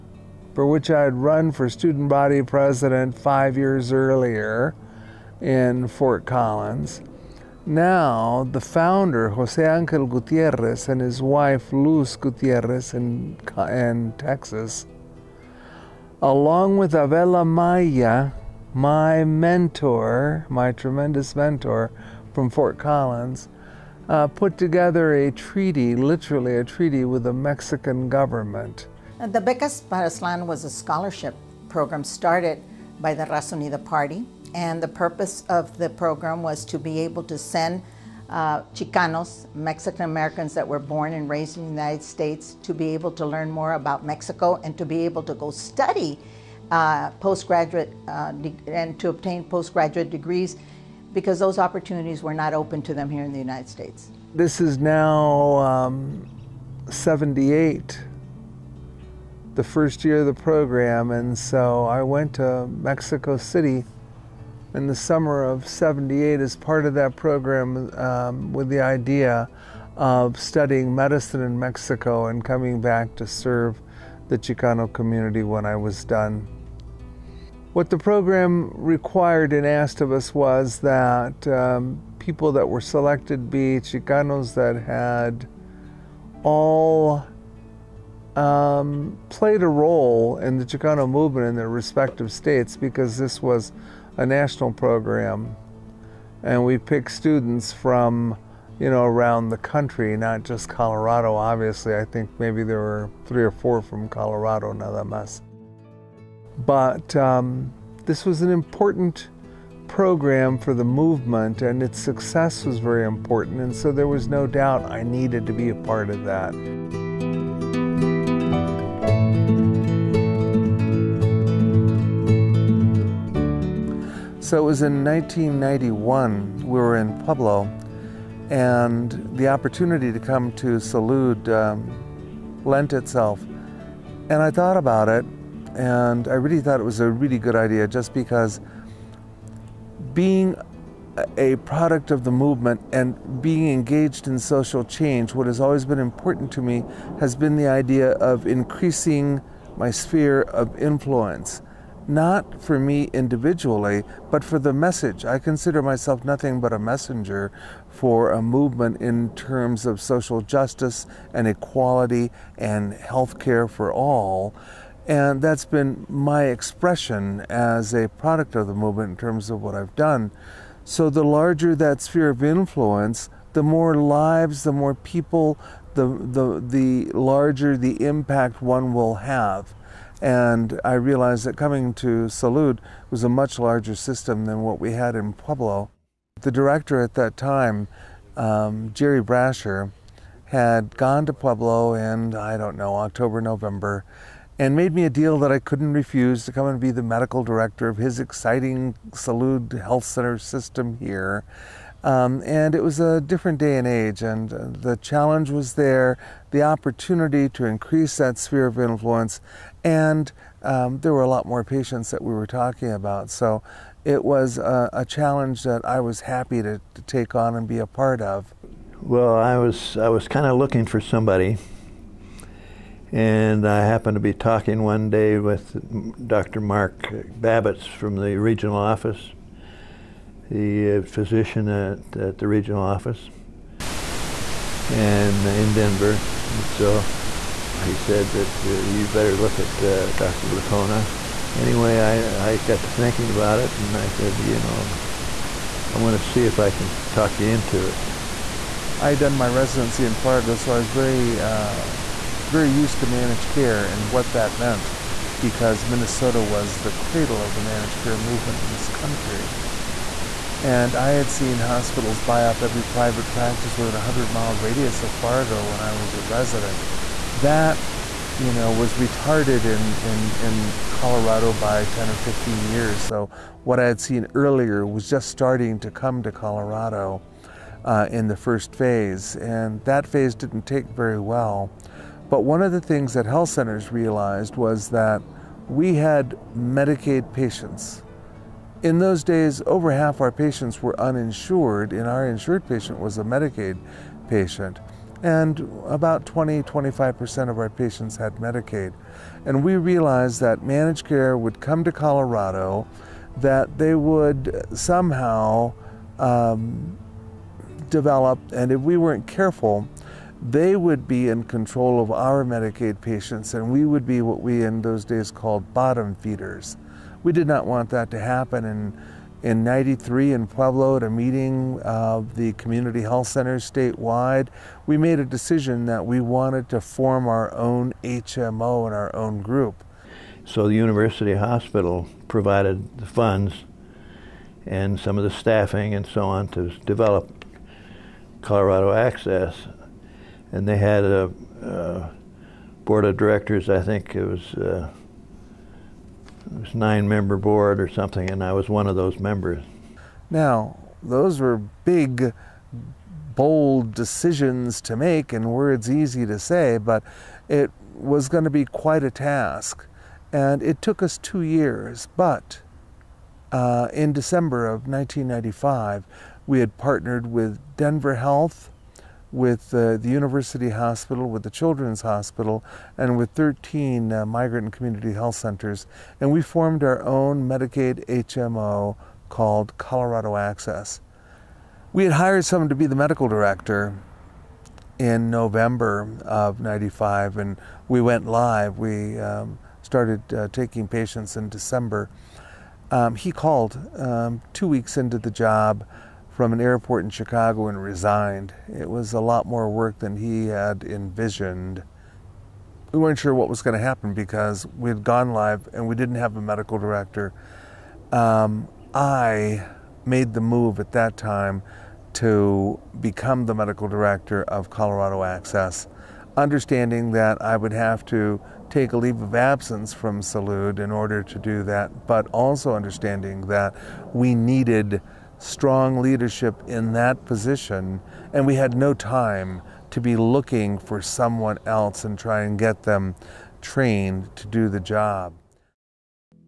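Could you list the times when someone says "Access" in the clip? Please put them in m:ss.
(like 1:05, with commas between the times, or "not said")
5:38, 6:20, 6:55.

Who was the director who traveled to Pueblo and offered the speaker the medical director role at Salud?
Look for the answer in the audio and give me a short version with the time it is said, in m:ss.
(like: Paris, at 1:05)
Jerry Brasher, at 3:08.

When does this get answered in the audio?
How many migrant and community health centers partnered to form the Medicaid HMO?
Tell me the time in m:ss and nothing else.
6:13.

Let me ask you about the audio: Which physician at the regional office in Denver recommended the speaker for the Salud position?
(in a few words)
Dr. Mark Babbitts.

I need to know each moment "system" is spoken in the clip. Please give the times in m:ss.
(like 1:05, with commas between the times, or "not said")
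3:03, 3:20.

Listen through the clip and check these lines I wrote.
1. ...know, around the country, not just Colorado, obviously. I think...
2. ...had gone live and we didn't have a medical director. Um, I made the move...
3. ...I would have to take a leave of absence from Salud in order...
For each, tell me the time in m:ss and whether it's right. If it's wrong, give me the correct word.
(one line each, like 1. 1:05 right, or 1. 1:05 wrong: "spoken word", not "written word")
1. 1:38 right
2. 6:44 right
3. 6:57 right.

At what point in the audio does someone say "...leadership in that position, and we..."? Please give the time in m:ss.
7:05.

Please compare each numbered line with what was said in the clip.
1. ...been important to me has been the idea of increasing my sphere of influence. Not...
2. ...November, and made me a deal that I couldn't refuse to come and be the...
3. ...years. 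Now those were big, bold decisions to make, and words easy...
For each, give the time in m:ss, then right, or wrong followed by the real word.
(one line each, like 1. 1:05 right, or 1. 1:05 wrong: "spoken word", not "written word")
1. 2:25 right
2. 3:13 right
3. 5:49 wrong: "members", not "years".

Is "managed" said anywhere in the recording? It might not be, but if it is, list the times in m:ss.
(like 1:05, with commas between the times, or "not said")
4:13, 4:17, 5:00.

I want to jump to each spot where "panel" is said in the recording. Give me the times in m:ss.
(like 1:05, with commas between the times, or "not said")
not said.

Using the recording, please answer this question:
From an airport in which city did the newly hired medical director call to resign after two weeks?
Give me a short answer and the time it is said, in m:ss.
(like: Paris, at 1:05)
Chicago, at 6:37.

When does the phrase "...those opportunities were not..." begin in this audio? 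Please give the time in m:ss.
0:51.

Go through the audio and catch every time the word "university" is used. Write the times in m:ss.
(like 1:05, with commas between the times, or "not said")
5:30, 6:10.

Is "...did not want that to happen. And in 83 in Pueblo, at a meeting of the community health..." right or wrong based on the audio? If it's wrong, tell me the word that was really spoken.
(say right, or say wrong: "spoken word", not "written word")
wrong: "93", not "83".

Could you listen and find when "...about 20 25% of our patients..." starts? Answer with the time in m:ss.
4:55.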